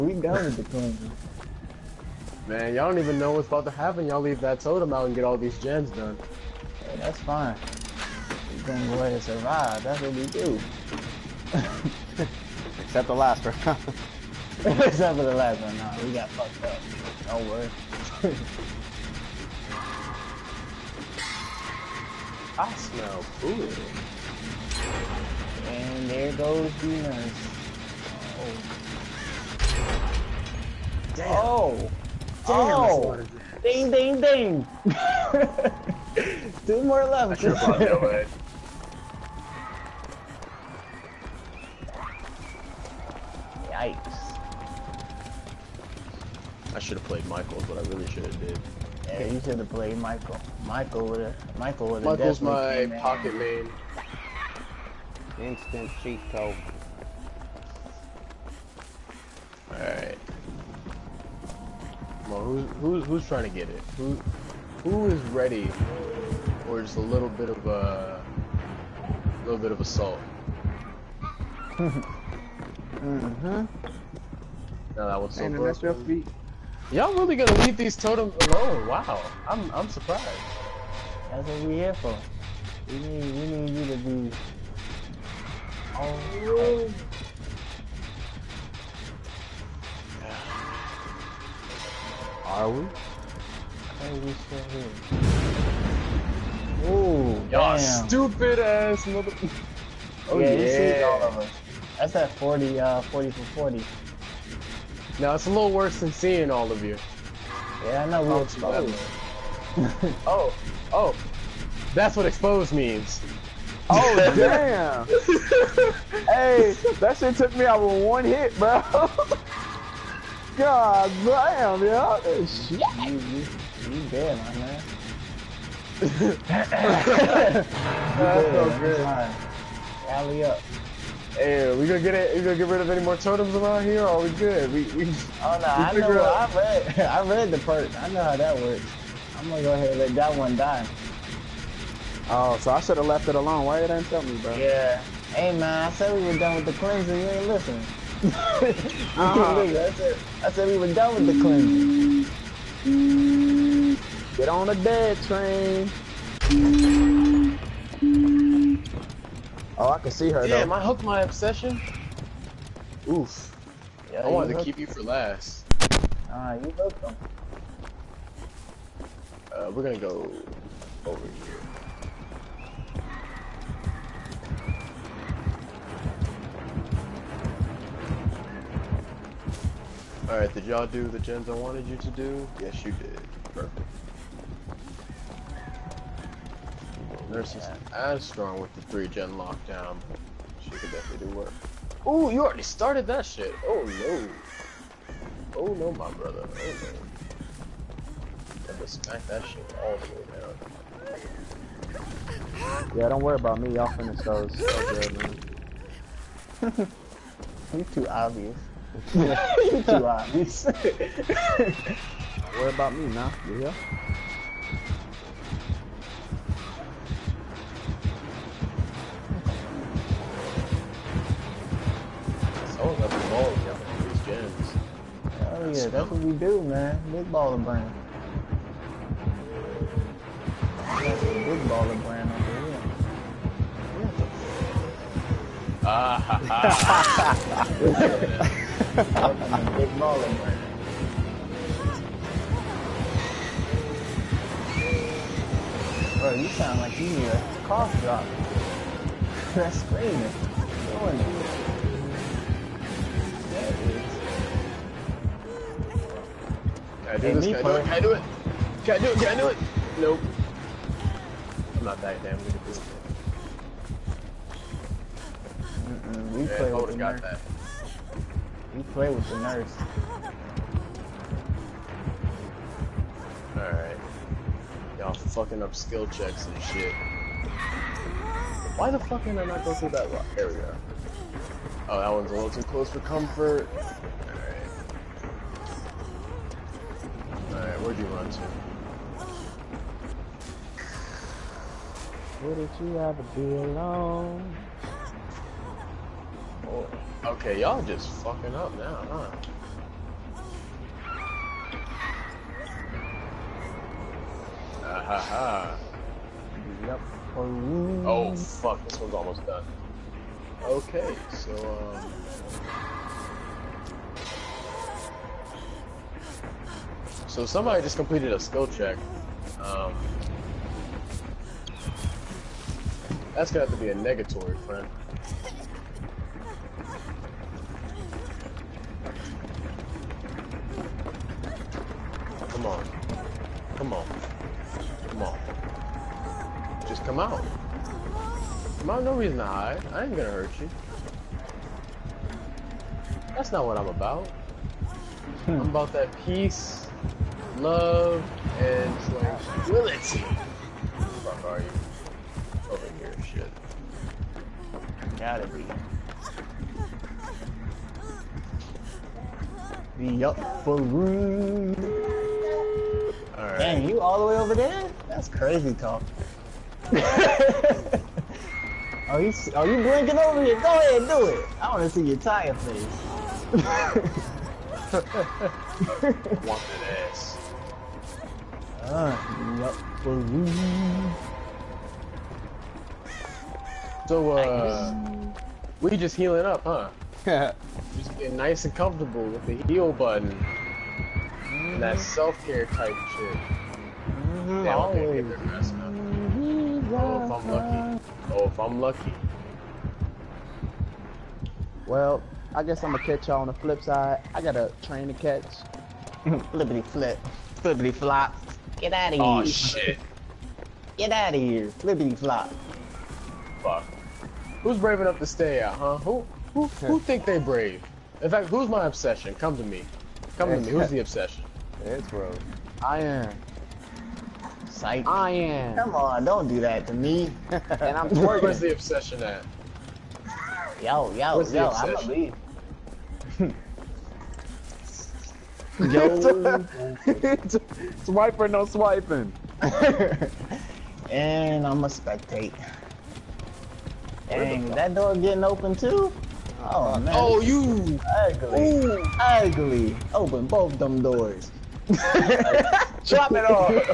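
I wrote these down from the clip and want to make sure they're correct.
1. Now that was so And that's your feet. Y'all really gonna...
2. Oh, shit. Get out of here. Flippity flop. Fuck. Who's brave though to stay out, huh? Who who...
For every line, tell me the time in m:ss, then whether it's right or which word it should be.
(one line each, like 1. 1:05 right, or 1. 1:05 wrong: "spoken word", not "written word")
1. 1:14 right
2. 6:49 wrong: "enough", not "though".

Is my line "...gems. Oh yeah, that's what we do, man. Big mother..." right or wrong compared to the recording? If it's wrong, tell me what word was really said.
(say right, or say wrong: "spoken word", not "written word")
wrong: "baller", not "mother".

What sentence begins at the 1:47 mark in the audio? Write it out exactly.
Yeah, I know we oh, exposed.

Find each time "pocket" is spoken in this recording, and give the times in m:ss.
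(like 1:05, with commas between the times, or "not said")
0:52.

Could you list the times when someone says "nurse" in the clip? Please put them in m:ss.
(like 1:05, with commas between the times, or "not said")
0:26, 3:07, 4:29.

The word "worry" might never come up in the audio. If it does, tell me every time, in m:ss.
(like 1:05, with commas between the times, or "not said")
0:17, 3:23, 3:30.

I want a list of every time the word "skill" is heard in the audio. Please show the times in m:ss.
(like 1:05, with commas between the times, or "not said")
4:35, 5:18.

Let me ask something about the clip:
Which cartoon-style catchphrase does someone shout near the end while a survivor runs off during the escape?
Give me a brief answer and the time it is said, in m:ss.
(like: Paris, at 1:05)
Swiper, no swiping, at 7:18.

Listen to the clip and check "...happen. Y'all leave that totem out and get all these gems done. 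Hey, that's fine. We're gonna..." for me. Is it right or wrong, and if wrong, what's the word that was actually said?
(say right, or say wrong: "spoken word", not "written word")
right.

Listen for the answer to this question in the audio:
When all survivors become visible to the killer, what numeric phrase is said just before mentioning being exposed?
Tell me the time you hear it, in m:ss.
1:43.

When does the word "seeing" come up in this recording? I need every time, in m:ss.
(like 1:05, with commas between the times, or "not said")
1:46.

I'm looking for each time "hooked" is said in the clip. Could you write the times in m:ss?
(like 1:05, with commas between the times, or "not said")
2:40, 2:46.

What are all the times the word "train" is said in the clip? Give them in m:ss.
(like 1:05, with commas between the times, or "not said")
2:35, 6:44.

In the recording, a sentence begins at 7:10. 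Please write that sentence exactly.
Yo, yo, Where's yo, I'm a lead.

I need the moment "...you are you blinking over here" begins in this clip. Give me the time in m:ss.
6:09.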